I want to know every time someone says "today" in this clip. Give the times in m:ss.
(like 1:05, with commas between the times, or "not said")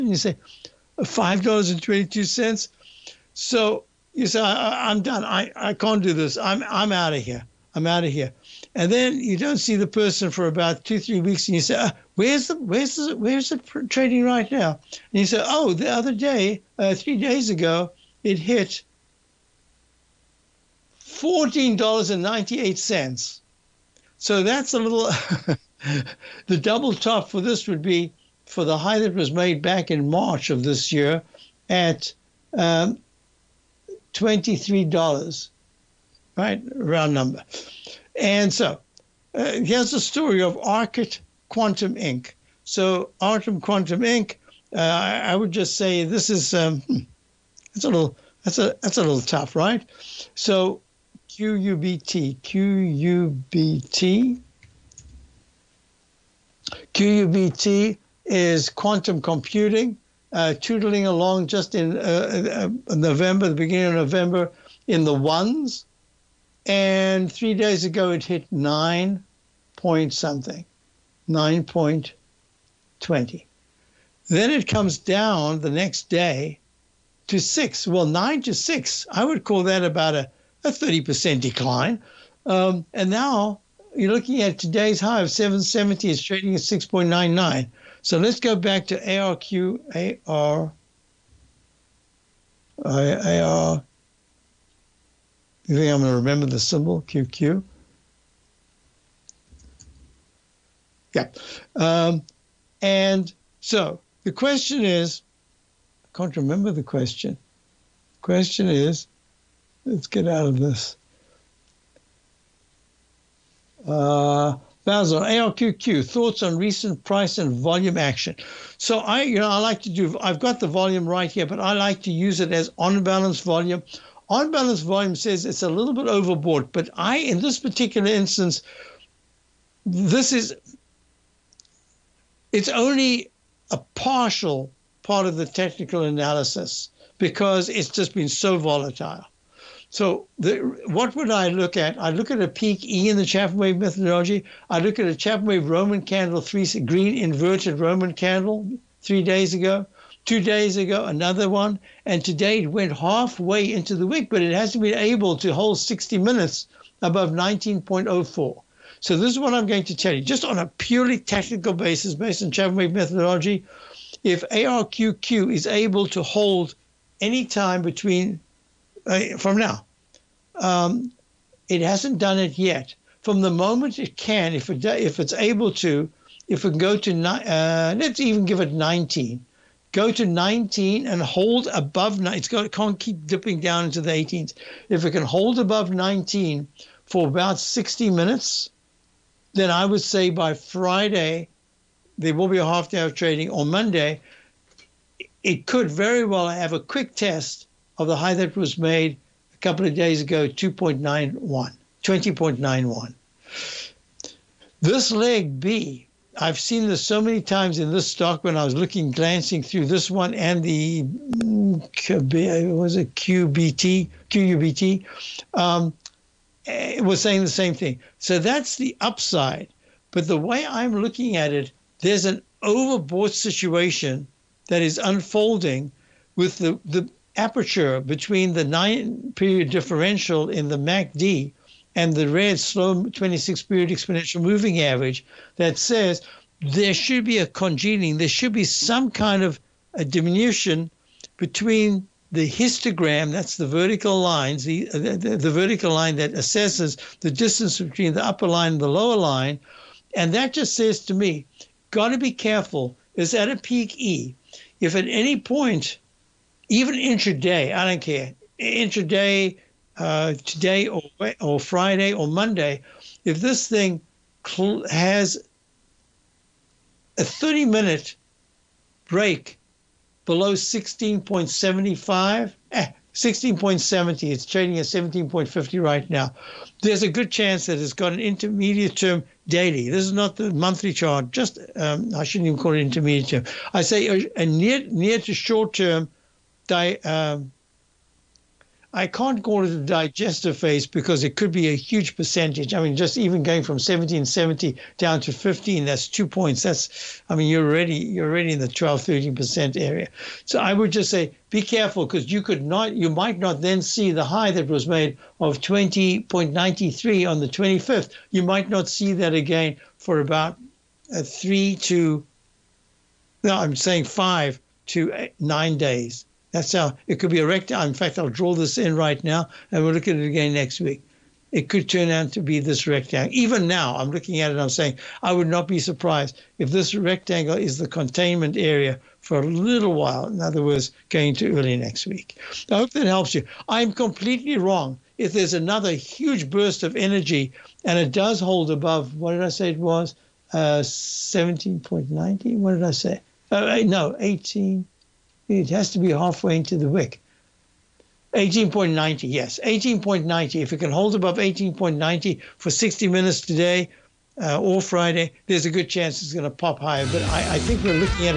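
1:24, 2:32, 4:20, 5:53.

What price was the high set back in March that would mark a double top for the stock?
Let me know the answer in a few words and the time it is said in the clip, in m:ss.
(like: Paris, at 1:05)
$23, at 0:34.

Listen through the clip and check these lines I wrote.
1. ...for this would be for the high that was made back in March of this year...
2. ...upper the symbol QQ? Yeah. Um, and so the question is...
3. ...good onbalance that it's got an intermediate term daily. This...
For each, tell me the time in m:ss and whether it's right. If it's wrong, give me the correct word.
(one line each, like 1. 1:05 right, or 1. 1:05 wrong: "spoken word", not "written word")
1. 0:27 right
2. 1:36 wrong: "remember", not "upper"
3. 4:37 wrong: "chance", not "onbalance".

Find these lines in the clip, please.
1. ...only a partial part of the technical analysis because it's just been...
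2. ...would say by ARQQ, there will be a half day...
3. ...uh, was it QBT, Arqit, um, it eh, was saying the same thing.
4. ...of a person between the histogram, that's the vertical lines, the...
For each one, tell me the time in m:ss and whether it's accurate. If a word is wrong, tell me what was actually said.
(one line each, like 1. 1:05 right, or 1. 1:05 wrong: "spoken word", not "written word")
1. 2:12 right
2. 3:09 wrong: "Friday", not "ARQQ"
3. 3:32 wrong: "QUBT", not "Arqit"
4. 3:59 wrong: "diminution", not "person".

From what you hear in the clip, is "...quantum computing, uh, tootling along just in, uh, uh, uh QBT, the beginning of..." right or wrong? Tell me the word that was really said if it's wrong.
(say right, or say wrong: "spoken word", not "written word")
wrong: "November", not "QBT".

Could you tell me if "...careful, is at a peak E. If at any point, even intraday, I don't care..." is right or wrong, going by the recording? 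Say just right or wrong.
right.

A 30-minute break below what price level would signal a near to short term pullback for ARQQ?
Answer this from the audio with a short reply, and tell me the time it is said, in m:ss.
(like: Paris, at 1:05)
16.70, at 4:33.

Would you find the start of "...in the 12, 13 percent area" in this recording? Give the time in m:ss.
4:58.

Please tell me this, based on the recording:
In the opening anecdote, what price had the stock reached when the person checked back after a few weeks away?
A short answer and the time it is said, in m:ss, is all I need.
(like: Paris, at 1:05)
$14.98, at 0:20.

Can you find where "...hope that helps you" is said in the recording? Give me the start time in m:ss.
5:32.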